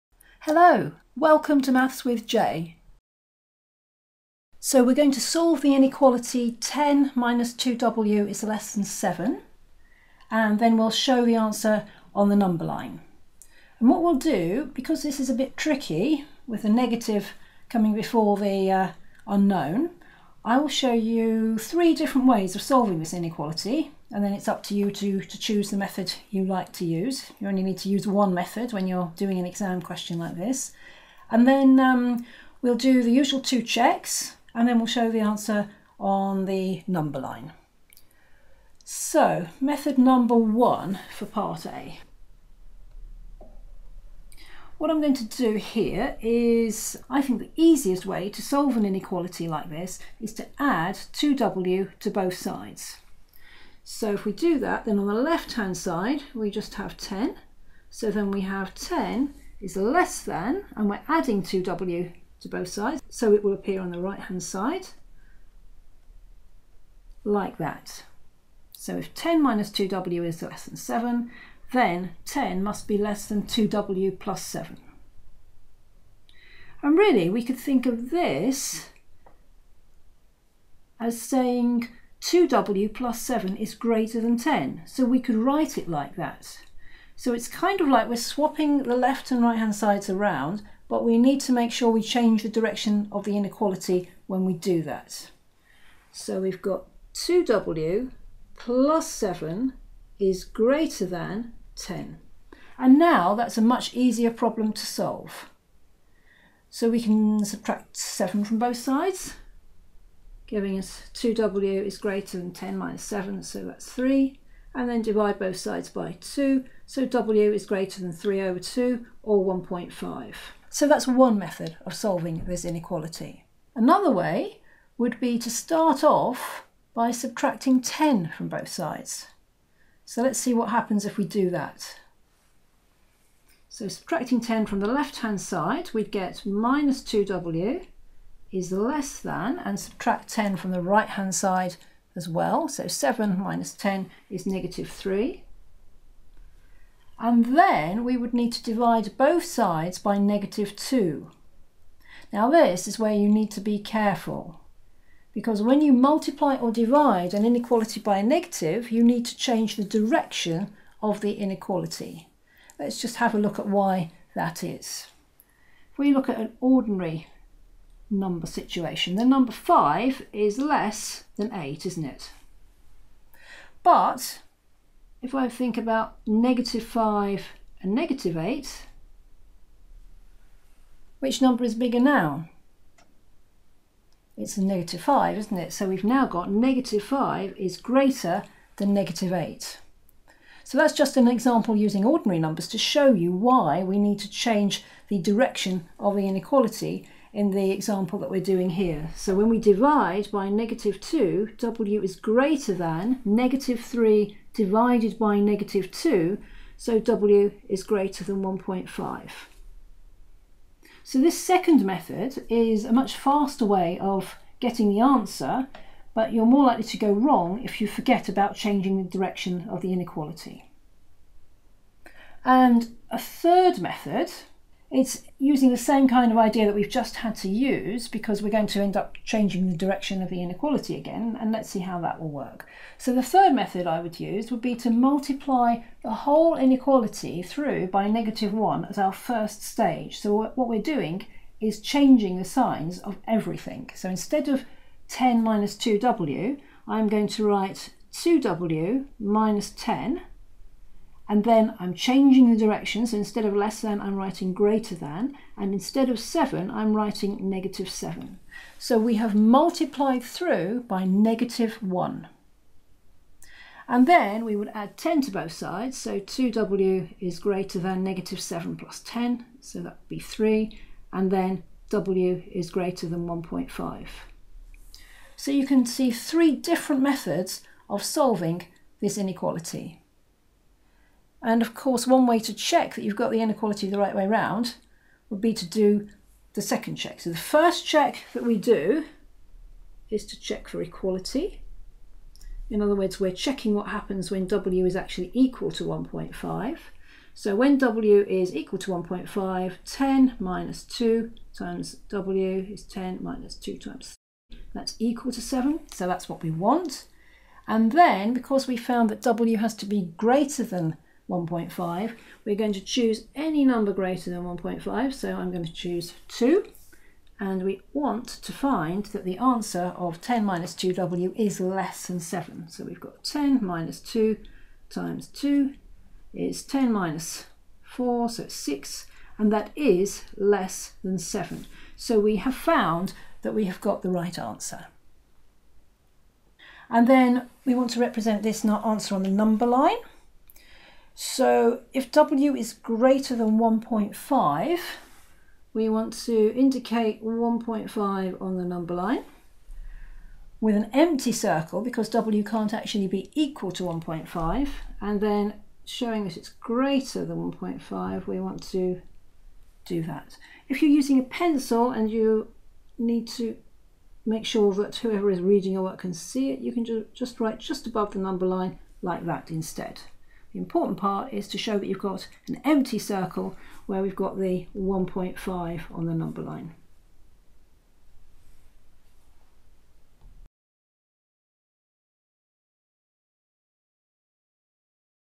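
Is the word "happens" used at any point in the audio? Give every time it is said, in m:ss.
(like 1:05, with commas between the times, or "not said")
2:10, 4:53.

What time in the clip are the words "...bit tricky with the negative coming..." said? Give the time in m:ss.
0:15.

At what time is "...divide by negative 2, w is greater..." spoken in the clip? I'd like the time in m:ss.
3:19.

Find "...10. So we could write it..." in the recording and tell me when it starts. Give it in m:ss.
1:24.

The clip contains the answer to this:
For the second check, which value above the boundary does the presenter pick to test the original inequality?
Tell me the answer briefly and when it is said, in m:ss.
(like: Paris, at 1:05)
2, at 5:15.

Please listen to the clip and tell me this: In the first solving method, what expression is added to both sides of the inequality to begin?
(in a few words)
2w.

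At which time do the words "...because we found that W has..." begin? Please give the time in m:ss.
5:08.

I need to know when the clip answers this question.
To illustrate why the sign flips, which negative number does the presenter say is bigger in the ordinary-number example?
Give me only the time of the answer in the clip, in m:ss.
3:04.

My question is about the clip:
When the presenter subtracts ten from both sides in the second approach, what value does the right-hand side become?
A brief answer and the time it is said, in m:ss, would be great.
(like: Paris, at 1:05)
-3, at 2:22.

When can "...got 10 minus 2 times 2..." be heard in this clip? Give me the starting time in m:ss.
5:22.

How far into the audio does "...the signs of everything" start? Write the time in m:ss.
4:02.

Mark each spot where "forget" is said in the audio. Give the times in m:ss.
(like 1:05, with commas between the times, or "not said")
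3:37.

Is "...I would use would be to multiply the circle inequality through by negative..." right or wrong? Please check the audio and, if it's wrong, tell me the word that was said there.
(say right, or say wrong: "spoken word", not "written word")
wrong: "whole", not "circle".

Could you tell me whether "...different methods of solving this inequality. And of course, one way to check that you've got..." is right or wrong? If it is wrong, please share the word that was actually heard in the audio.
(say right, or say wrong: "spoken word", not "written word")
right.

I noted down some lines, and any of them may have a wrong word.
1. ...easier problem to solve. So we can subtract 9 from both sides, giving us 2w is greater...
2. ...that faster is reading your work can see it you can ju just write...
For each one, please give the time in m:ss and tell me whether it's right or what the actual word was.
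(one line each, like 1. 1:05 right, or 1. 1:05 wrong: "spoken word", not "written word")
1. 1:43 wrong: "7", not "9"
2. 6:04 wrong: "whoever", not "faster".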